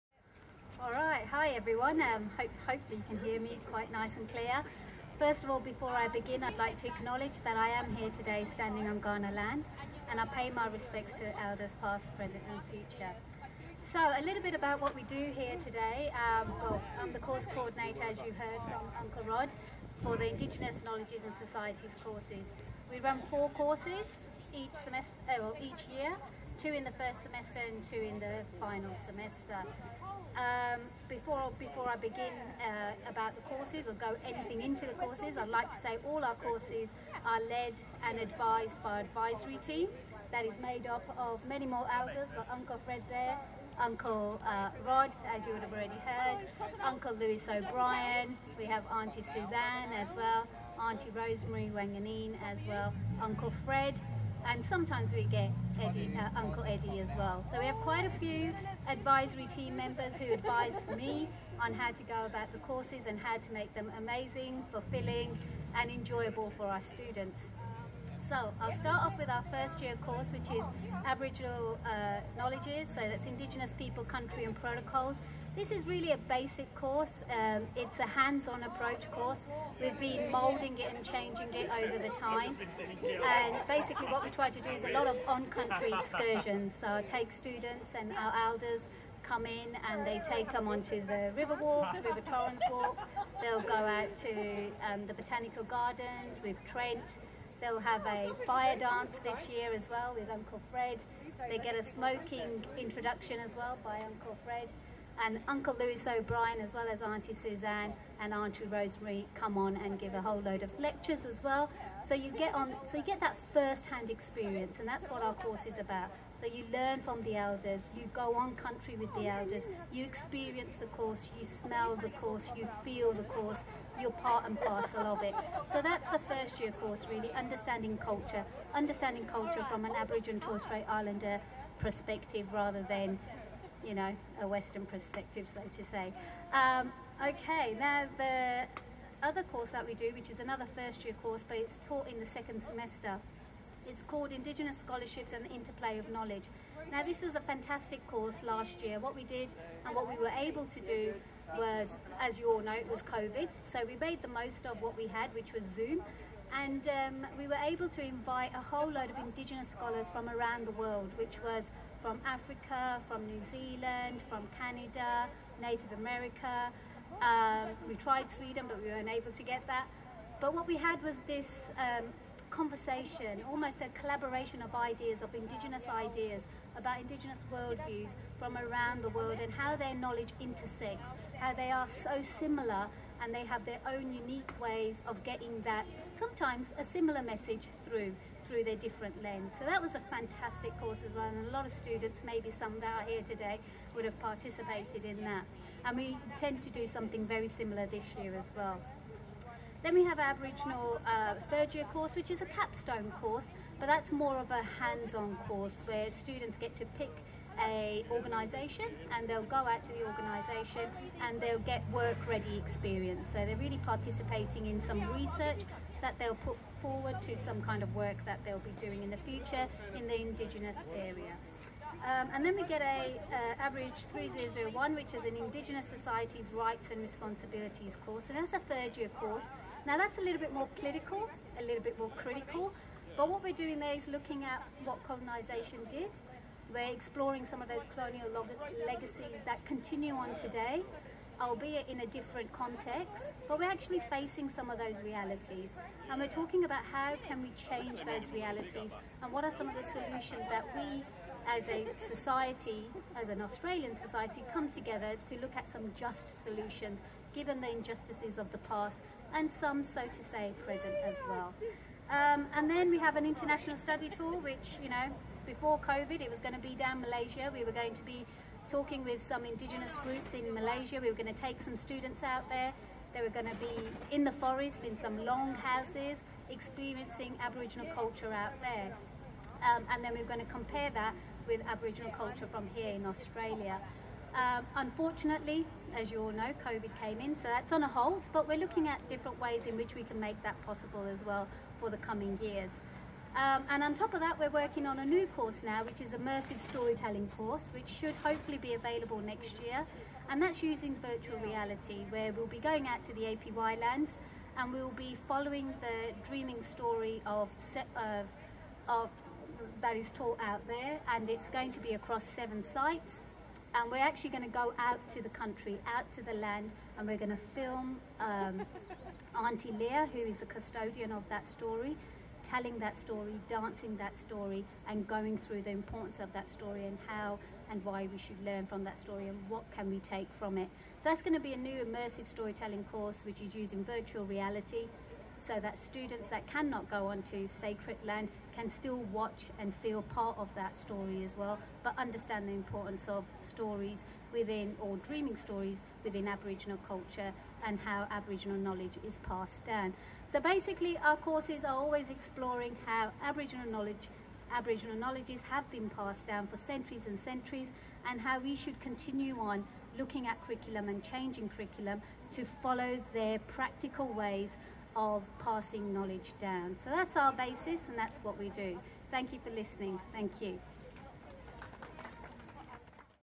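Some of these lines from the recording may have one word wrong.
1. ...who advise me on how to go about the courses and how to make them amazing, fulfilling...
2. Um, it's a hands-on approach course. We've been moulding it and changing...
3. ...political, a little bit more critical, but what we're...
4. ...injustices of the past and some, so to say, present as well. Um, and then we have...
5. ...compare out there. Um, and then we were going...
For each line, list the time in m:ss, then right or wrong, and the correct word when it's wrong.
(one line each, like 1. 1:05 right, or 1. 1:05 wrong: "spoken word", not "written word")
1. 1:00 right
2. 1:17 right
3. 3:50 right
4. 4:17 right
5. 4:37 wrong: "culture", not "compare".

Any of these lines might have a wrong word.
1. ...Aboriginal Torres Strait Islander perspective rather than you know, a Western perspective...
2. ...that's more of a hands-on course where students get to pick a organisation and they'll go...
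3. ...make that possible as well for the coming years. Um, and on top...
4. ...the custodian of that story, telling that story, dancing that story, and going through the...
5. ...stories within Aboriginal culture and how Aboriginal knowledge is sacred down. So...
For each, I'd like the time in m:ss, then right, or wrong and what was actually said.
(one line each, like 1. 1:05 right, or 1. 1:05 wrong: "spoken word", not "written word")
1. 2:09 right
2. 3:23 right
3. 4:50 right
4. 5:20 right
5. 5:45 wrong: "passed", not "sacred".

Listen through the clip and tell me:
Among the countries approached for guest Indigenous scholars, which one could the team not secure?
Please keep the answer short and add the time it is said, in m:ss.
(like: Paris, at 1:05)
Sweden, at 2:48.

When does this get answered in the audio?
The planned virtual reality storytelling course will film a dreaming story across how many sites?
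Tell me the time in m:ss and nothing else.
5:12.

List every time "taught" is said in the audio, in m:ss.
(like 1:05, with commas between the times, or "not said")
2:21, 5:10.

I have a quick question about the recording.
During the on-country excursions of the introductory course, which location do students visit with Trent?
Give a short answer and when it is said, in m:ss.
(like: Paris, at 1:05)
Botanical Gardens, at 1:35.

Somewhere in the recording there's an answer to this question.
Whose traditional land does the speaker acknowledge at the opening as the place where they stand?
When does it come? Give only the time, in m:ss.
0:09.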